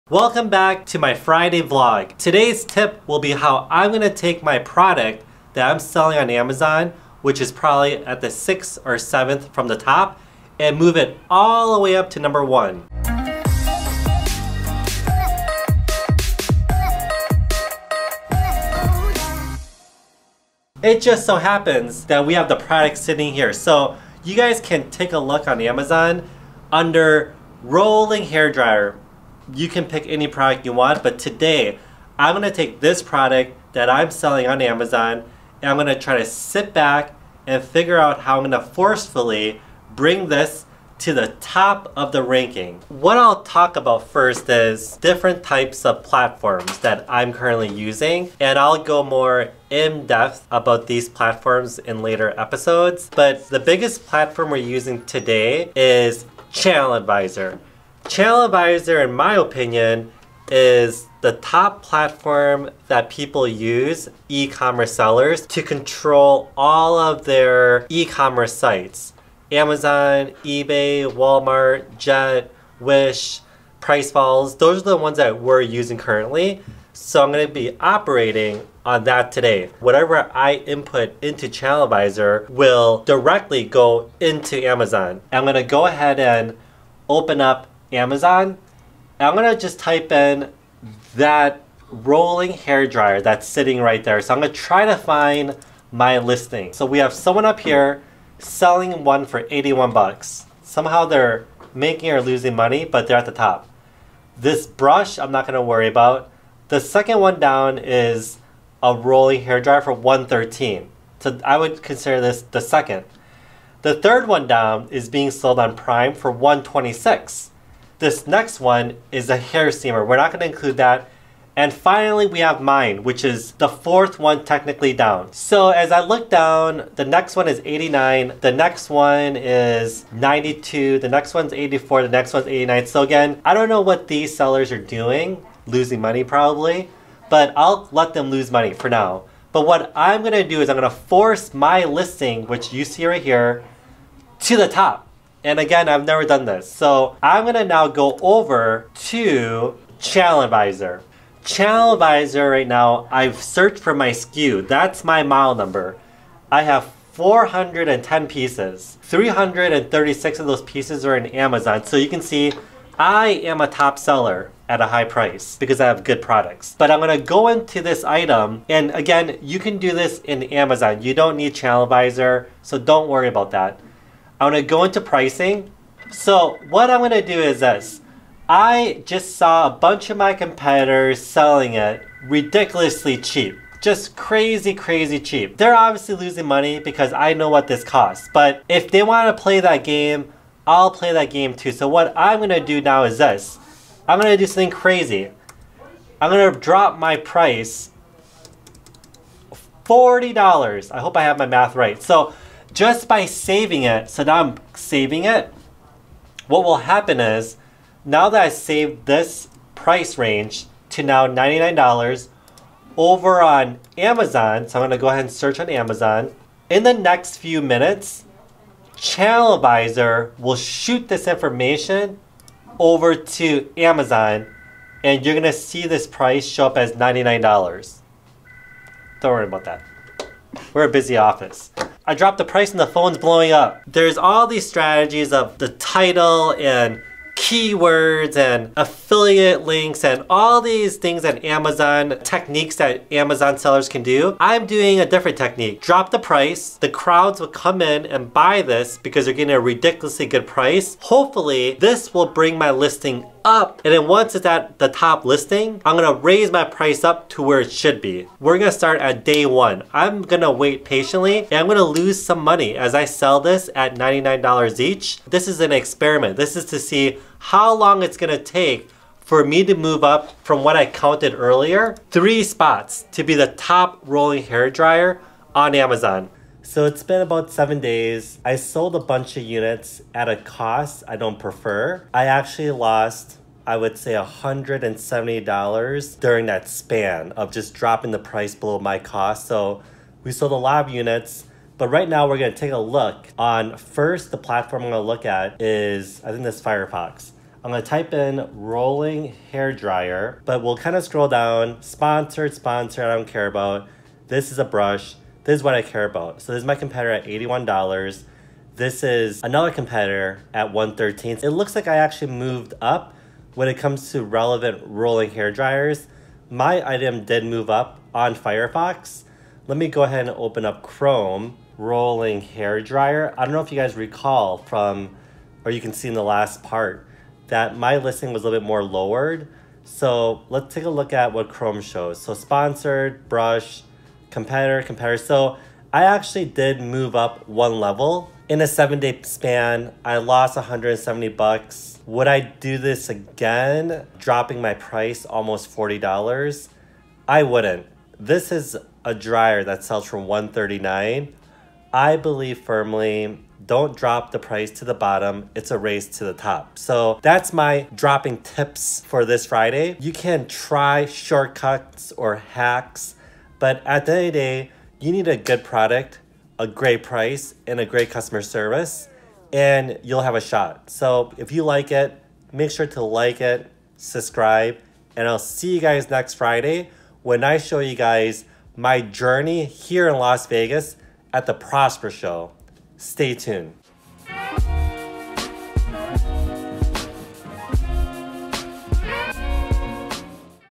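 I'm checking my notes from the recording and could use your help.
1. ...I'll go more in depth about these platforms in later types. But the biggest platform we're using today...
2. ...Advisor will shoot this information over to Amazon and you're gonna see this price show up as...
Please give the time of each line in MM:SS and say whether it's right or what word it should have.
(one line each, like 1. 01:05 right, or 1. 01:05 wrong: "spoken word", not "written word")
1. 00:48 wrong: "episodes", not "types"
2. 03:39 right.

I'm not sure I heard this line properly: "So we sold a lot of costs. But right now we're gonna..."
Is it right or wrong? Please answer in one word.
wrong.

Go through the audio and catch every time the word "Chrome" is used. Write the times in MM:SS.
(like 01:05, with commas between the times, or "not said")
05:20, 05:31.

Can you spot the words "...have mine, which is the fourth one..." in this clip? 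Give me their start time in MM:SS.
02:02.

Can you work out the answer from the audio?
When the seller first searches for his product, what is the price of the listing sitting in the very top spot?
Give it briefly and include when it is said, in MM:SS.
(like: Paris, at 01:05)
$81, at 01:39.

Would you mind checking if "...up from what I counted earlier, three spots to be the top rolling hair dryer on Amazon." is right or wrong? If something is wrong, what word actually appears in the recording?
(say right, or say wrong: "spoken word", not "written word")
right.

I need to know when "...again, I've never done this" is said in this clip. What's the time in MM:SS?
02:25.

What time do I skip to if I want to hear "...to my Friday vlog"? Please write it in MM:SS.
00:00.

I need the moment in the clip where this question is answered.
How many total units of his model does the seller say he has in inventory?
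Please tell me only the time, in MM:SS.
02:37.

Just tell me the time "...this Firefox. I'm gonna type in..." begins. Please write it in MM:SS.
04:56.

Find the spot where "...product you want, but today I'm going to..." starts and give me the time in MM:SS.
00:30.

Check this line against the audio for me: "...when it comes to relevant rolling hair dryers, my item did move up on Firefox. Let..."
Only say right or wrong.
right.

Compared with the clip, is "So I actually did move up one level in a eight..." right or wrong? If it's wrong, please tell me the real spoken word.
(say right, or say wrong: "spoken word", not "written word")
wrong: "seven", not "eight".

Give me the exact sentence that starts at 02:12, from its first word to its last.
So again, I don't know what these sellers are doing, losing money probably, but I'll let them lose money for now.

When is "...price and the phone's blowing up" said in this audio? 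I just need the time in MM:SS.
03:52.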